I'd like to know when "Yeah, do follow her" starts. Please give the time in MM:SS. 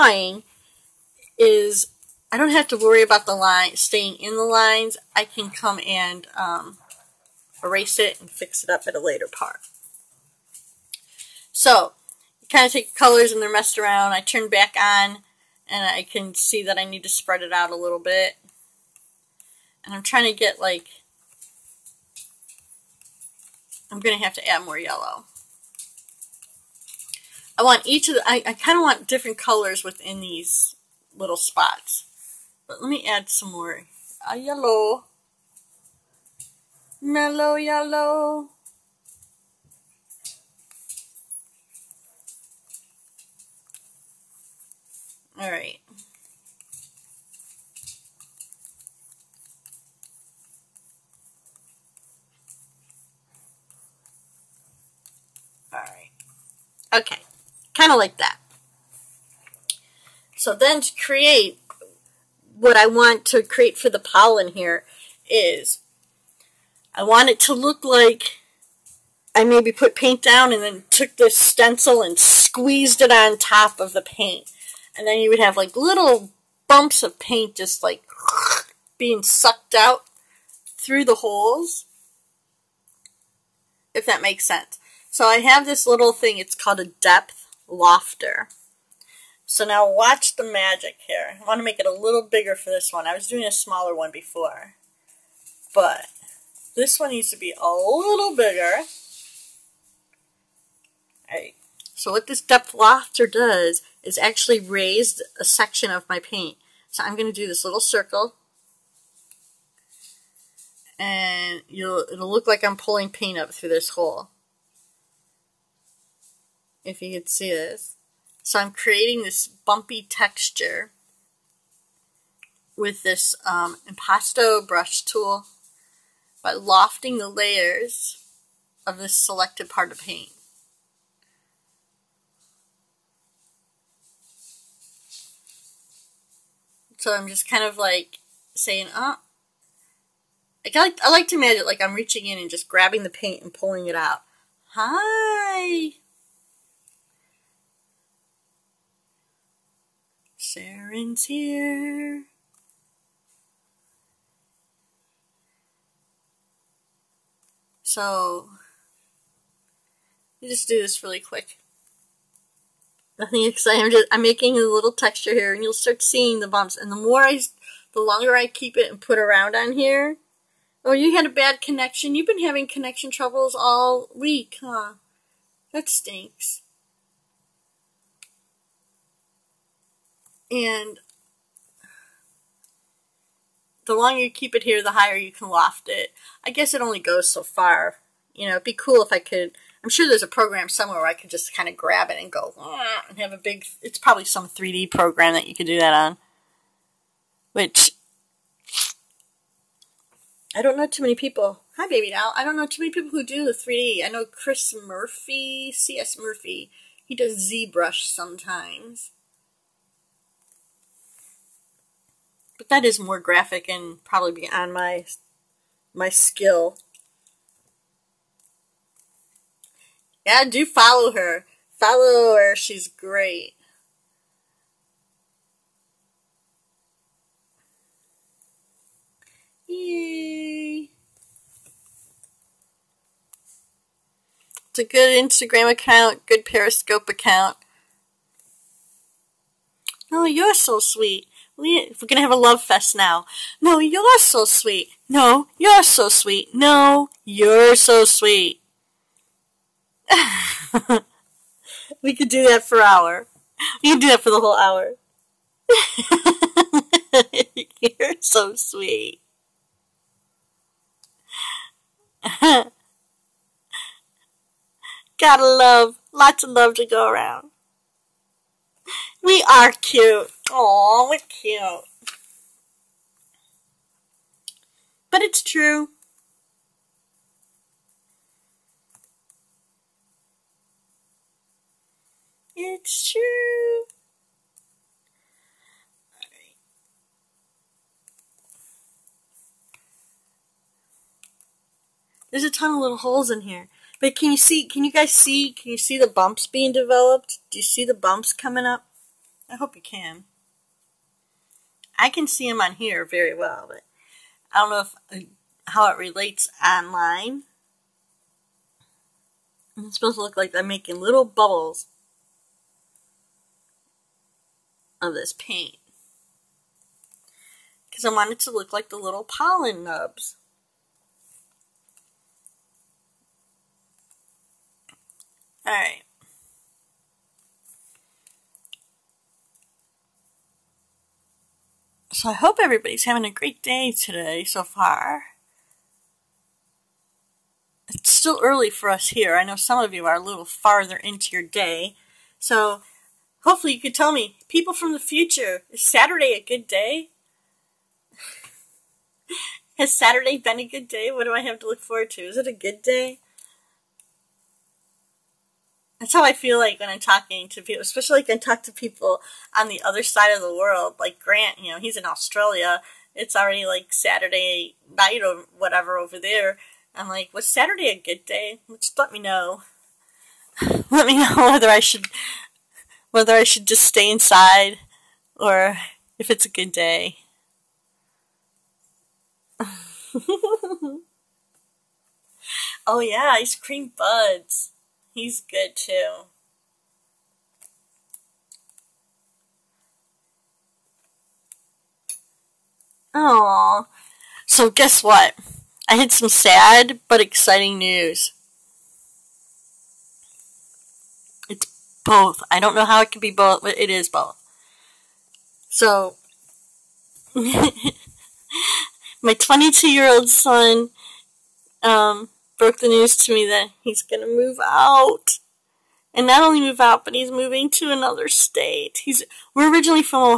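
03:40.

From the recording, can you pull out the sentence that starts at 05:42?
So hopefully you can tell me, people from the future, is Saturday a good day?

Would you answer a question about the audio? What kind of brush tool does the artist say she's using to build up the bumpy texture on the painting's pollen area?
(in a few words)
impasto brush tool.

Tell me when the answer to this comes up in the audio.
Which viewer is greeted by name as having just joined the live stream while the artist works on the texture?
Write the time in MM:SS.
02:30.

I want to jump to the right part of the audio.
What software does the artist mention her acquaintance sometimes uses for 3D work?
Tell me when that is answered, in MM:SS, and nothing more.
03:27.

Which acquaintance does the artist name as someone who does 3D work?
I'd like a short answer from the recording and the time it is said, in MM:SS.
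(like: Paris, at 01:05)
Chris Murphy, at 03:24.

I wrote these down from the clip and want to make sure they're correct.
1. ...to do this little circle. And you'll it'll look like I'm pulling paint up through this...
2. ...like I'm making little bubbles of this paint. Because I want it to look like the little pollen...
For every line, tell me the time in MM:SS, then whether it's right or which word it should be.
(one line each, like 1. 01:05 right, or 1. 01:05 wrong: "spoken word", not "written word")
1. 01:47 right
2. 05:10 right.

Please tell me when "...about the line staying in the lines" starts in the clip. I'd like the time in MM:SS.
00:03.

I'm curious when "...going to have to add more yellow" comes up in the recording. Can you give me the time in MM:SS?
00:24.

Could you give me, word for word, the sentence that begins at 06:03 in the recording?
It's already like Saturday night or whatever over there.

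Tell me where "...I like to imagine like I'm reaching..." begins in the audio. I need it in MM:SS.
02:21.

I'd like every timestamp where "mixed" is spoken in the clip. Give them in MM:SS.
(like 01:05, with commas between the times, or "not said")
not said.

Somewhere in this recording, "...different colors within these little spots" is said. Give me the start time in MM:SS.
00:29.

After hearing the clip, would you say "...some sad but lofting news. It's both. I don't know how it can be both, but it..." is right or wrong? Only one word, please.
wrong.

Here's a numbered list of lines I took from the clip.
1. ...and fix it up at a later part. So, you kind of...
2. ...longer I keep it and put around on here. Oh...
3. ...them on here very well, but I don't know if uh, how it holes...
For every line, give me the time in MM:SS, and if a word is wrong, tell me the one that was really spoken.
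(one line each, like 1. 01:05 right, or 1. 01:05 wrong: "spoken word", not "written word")
1. 00:08 right
2. 02:48 right
3. 05:02 wrong: "relates", not "holes".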